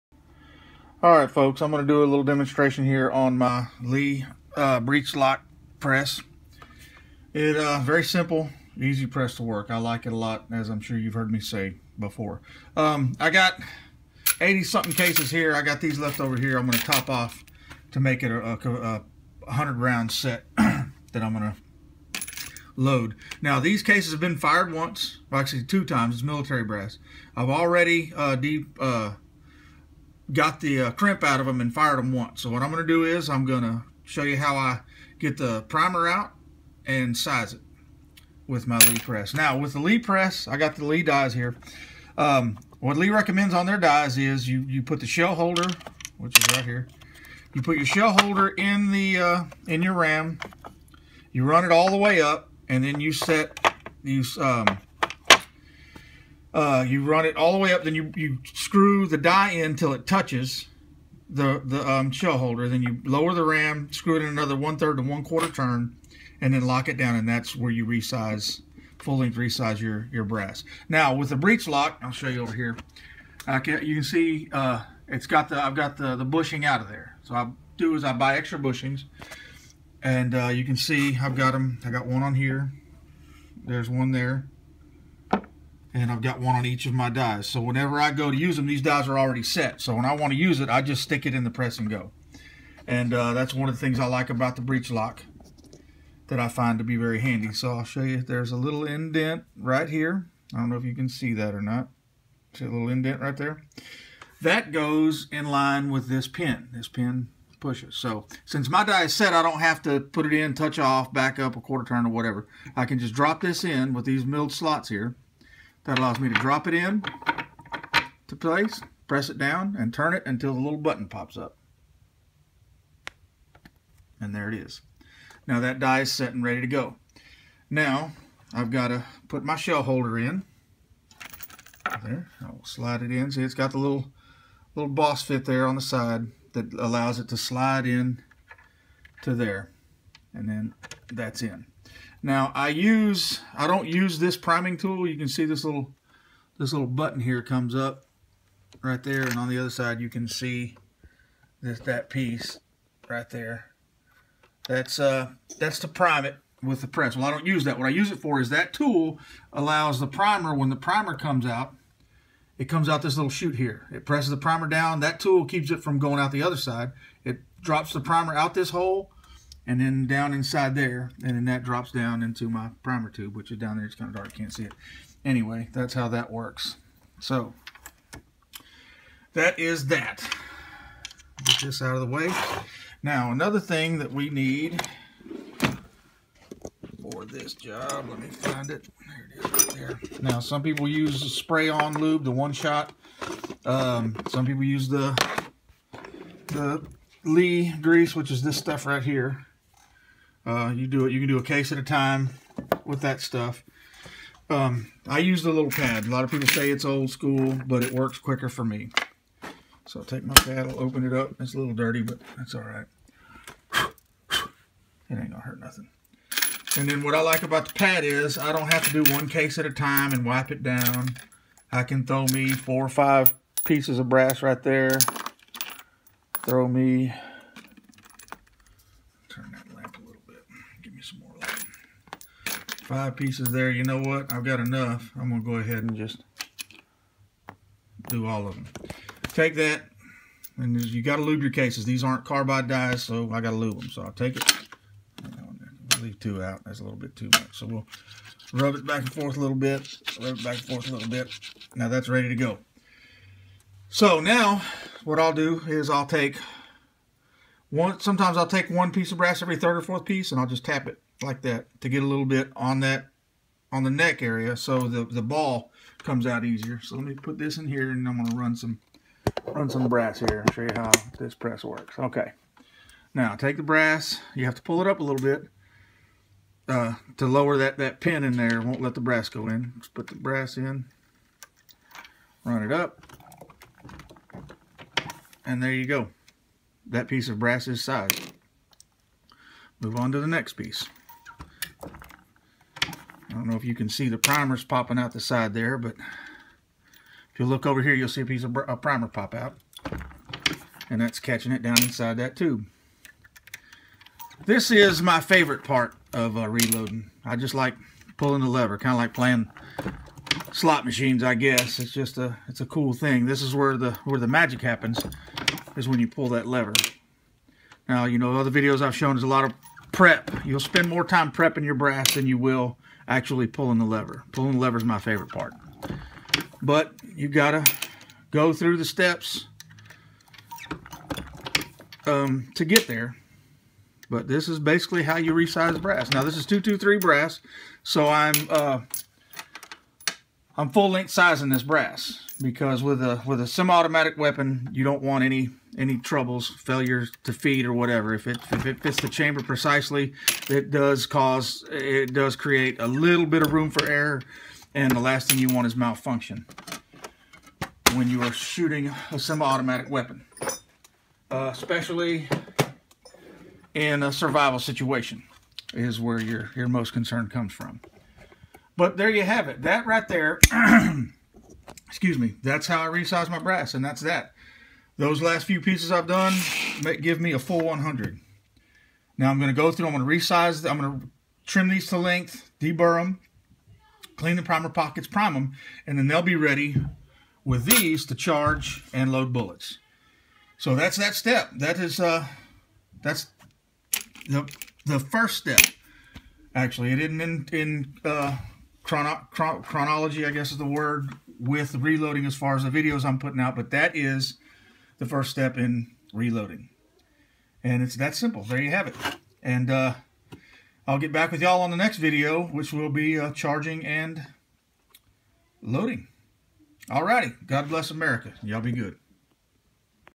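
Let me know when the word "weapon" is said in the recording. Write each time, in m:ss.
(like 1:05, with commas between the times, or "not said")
5:44, 5:59.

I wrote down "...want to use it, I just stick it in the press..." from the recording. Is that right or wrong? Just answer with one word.
right.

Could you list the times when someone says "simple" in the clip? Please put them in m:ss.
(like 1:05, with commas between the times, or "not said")
0:08, 6:48.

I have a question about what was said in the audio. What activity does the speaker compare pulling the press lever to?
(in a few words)
playing slot machines.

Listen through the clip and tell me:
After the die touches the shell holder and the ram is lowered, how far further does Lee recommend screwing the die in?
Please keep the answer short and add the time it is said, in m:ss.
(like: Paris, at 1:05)
one-third to one-quarter turn, at 1:04.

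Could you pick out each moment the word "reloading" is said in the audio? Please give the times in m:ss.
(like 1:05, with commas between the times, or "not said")
5:06, 6:41, 6:46.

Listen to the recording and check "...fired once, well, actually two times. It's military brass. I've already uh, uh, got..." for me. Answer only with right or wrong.
right.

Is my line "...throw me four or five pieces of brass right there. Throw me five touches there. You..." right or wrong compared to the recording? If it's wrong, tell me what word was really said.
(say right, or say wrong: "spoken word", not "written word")
wrong: "pieces", not "touches".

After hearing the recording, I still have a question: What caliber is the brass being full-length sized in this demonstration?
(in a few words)
223.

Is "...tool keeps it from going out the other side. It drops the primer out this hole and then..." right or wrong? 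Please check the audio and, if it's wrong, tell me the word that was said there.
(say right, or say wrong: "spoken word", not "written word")
right.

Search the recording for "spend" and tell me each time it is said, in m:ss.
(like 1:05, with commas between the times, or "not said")
5:20.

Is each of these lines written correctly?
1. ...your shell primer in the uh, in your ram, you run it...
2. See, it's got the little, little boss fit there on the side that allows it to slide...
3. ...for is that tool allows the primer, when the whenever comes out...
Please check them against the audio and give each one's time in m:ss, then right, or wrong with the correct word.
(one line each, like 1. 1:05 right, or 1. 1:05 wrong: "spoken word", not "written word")
1. 0:47 wrong: "holder", not "primer"
2. 2:13 right
3. 2:38 wrong: "primer", not "whenever".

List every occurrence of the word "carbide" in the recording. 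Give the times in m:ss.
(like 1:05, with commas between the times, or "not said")
4:02.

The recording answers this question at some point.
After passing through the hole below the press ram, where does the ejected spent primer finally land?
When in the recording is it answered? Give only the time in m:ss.
2:52.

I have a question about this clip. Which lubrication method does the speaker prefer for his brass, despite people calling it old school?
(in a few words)
the pad.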